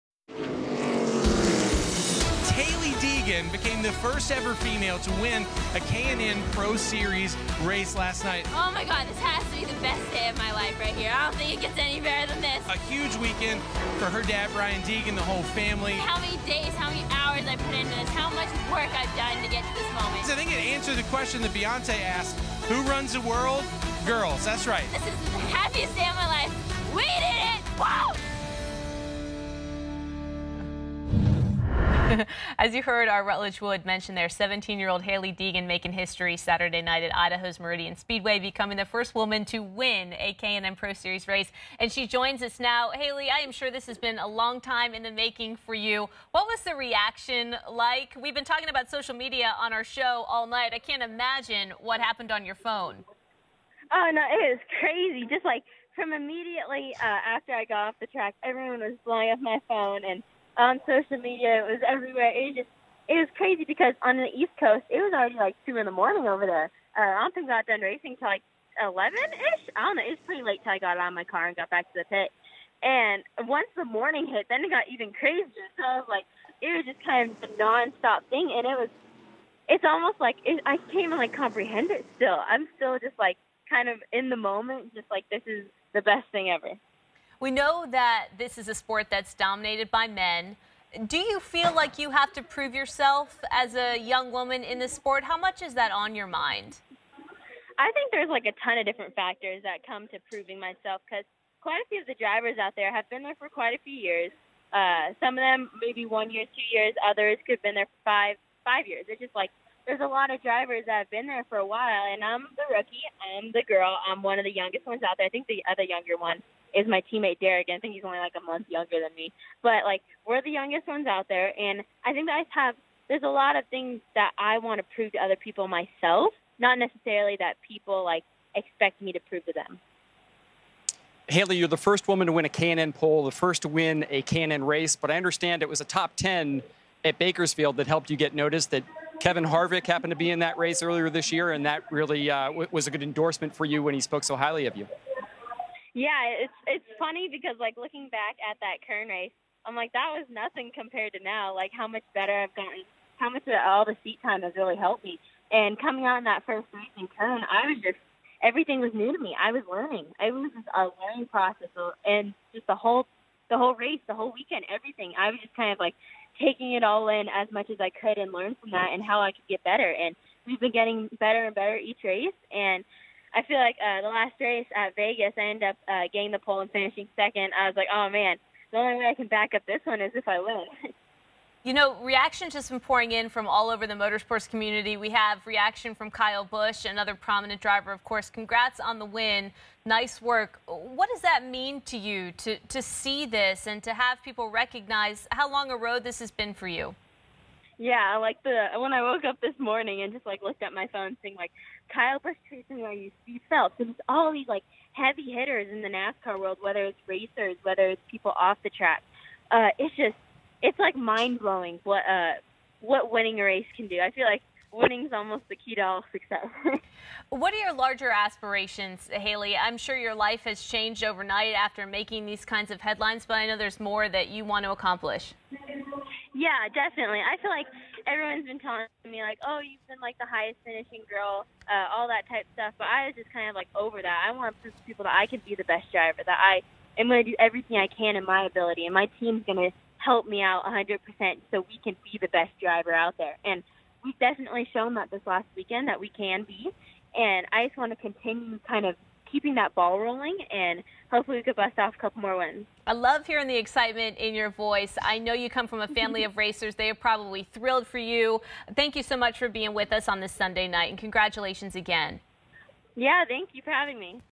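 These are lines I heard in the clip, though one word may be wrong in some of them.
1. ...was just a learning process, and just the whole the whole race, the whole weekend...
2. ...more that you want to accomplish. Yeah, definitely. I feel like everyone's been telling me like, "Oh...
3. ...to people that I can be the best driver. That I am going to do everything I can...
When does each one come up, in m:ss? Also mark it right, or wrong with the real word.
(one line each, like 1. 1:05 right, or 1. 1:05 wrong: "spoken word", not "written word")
1. 2:40 right
2. 3:43 right
3. 3:54 right.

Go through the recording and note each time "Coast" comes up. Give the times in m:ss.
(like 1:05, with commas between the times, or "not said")
1:04.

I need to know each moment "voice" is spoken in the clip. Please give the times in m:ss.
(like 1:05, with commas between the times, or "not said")
4:14.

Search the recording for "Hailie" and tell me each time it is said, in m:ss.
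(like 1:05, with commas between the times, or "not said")
0:35, 0:42, 2:11, 3:39.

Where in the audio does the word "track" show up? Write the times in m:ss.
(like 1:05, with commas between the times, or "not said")
0:58, 3:28.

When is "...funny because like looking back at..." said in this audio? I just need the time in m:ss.
2:26.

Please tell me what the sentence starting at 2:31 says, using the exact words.
Like how much better I've gotten, how much all the seat time has really helped me.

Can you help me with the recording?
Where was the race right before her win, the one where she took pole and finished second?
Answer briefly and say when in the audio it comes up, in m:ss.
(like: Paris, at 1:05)
Vegas, at 2:54.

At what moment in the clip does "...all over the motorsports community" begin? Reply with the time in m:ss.
3:03.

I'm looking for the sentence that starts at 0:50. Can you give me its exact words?
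I can't imagine what happened on your phone.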